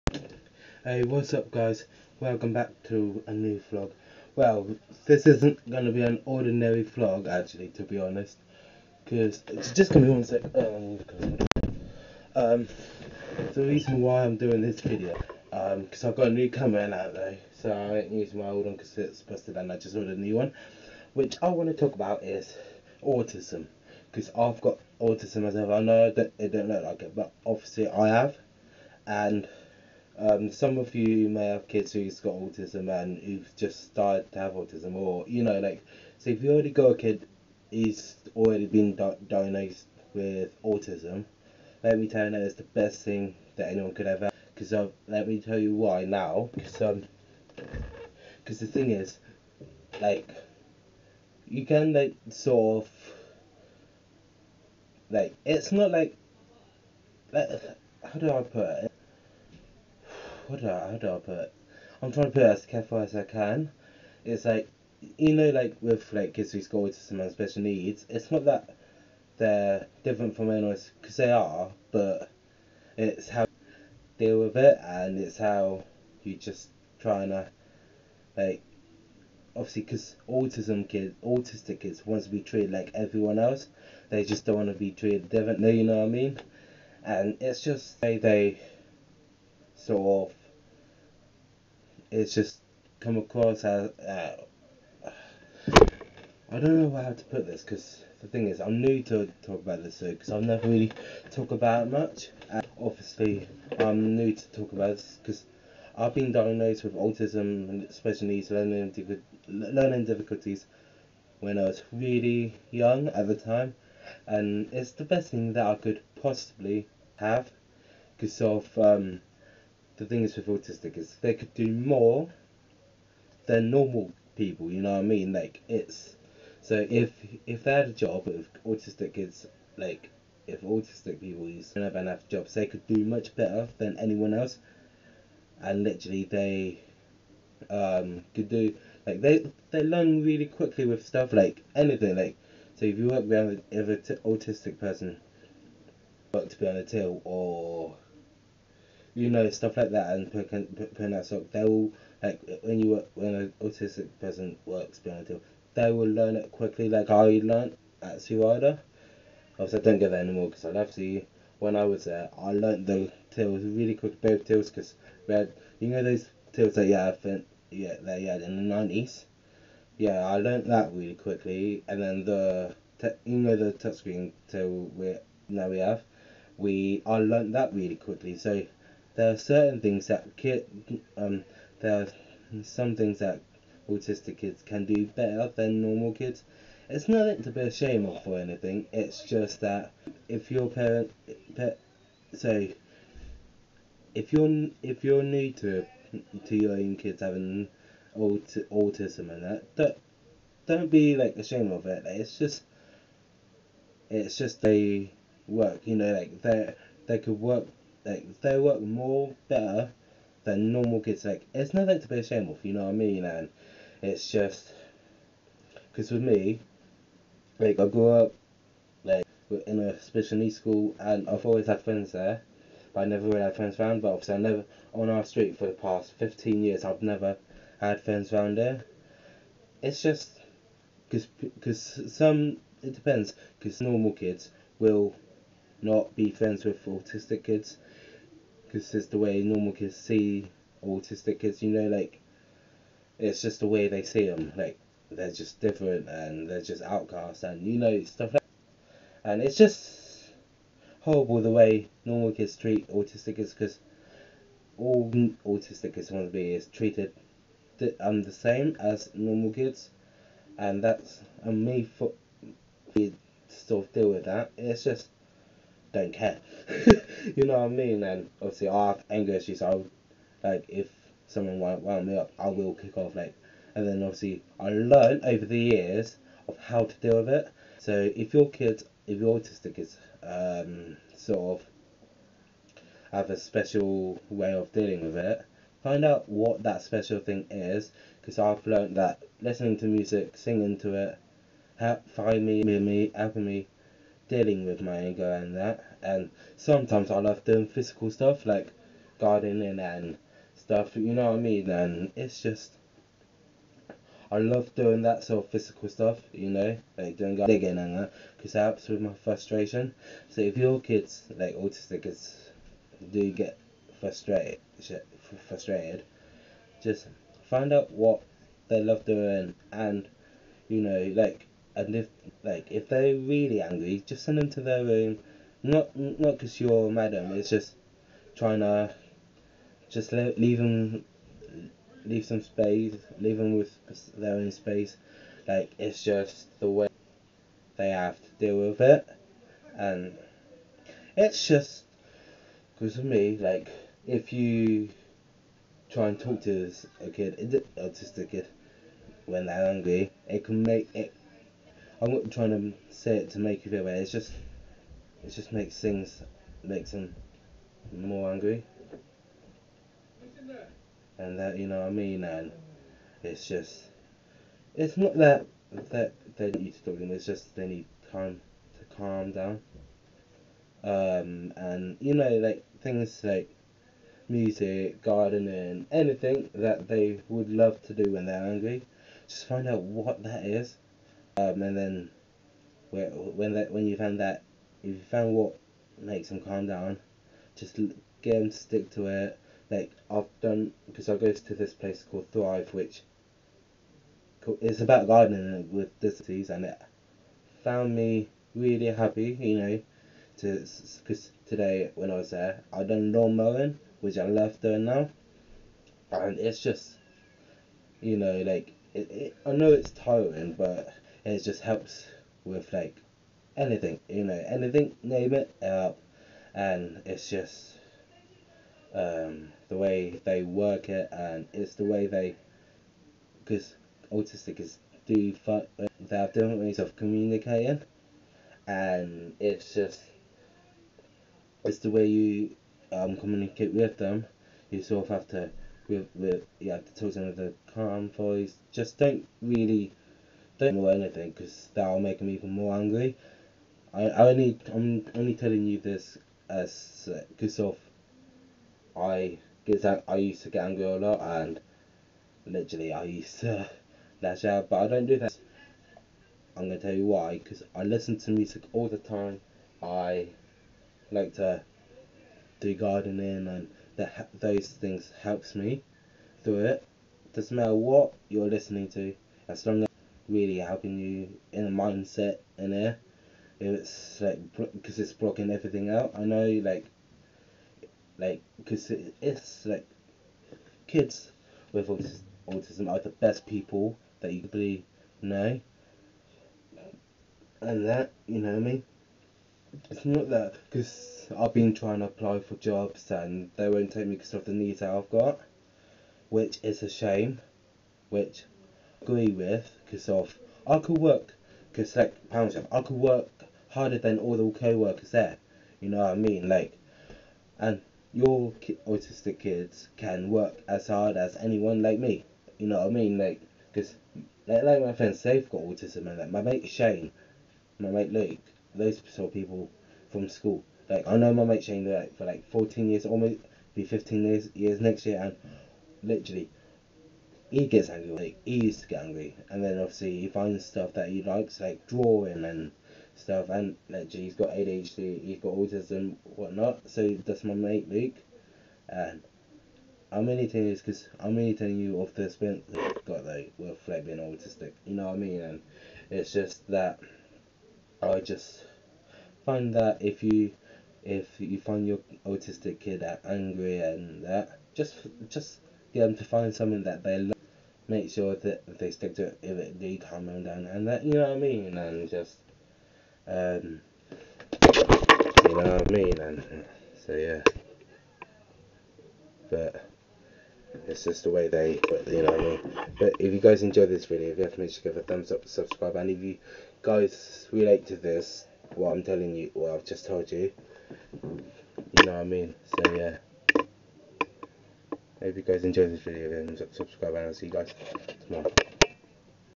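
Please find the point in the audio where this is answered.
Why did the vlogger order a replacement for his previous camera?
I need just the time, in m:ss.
0:19.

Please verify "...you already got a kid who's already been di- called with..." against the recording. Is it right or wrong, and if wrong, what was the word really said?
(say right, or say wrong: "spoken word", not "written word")
wrong: "diagnosed", not "called".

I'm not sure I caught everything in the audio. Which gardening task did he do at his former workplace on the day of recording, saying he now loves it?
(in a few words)
lawn mowing.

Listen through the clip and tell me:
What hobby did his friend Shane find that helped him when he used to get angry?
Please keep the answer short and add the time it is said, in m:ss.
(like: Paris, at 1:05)
drawing, at 8:51.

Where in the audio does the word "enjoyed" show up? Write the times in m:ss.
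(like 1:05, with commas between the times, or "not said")
9:33, 9:45.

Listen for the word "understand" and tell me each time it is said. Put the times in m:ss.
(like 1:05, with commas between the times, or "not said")
not said.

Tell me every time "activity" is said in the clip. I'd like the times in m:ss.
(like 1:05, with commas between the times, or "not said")
not said.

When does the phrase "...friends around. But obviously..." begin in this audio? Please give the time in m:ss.
3:43.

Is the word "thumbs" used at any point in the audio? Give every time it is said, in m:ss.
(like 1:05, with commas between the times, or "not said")
9:35.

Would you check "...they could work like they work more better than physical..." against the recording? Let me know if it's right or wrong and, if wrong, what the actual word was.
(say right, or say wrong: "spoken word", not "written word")
wrong: "normal", not "physical".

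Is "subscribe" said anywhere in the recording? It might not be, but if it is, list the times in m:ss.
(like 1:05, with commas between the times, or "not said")
9:35, 9:46.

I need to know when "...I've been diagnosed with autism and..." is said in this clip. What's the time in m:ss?
1:45.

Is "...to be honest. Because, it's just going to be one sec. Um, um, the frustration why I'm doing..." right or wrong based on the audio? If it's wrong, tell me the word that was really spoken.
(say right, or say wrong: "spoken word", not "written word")
wrong: "reason", not "frustration".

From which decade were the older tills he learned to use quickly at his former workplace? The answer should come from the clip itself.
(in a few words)
the 90s.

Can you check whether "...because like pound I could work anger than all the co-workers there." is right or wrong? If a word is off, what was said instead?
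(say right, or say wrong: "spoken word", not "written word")
wrong: "harder", not "anger".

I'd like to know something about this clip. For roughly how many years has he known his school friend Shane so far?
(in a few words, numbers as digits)
14 years.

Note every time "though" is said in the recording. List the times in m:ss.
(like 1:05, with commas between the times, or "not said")
0:17, 9:03.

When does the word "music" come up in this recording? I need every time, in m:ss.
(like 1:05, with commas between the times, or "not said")
4:49, 6:14, 7:38.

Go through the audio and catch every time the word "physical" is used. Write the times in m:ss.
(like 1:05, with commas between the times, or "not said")
4:57, 5:05.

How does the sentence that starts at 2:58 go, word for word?
So there are certain things that kid, um, there are some things that autistic kids can do better than normal kids.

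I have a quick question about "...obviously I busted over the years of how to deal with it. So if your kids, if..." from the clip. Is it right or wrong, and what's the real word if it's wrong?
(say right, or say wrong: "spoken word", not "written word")
wrong: "learned", not "busted".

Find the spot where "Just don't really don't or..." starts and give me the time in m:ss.
7:18.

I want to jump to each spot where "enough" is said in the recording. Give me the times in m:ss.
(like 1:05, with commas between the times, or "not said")
2:11.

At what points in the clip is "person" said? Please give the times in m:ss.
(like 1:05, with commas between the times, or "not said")
2:24, 2:34.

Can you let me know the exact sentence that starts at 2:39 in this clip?
Obviously, I don't get that anymore because I left Sea.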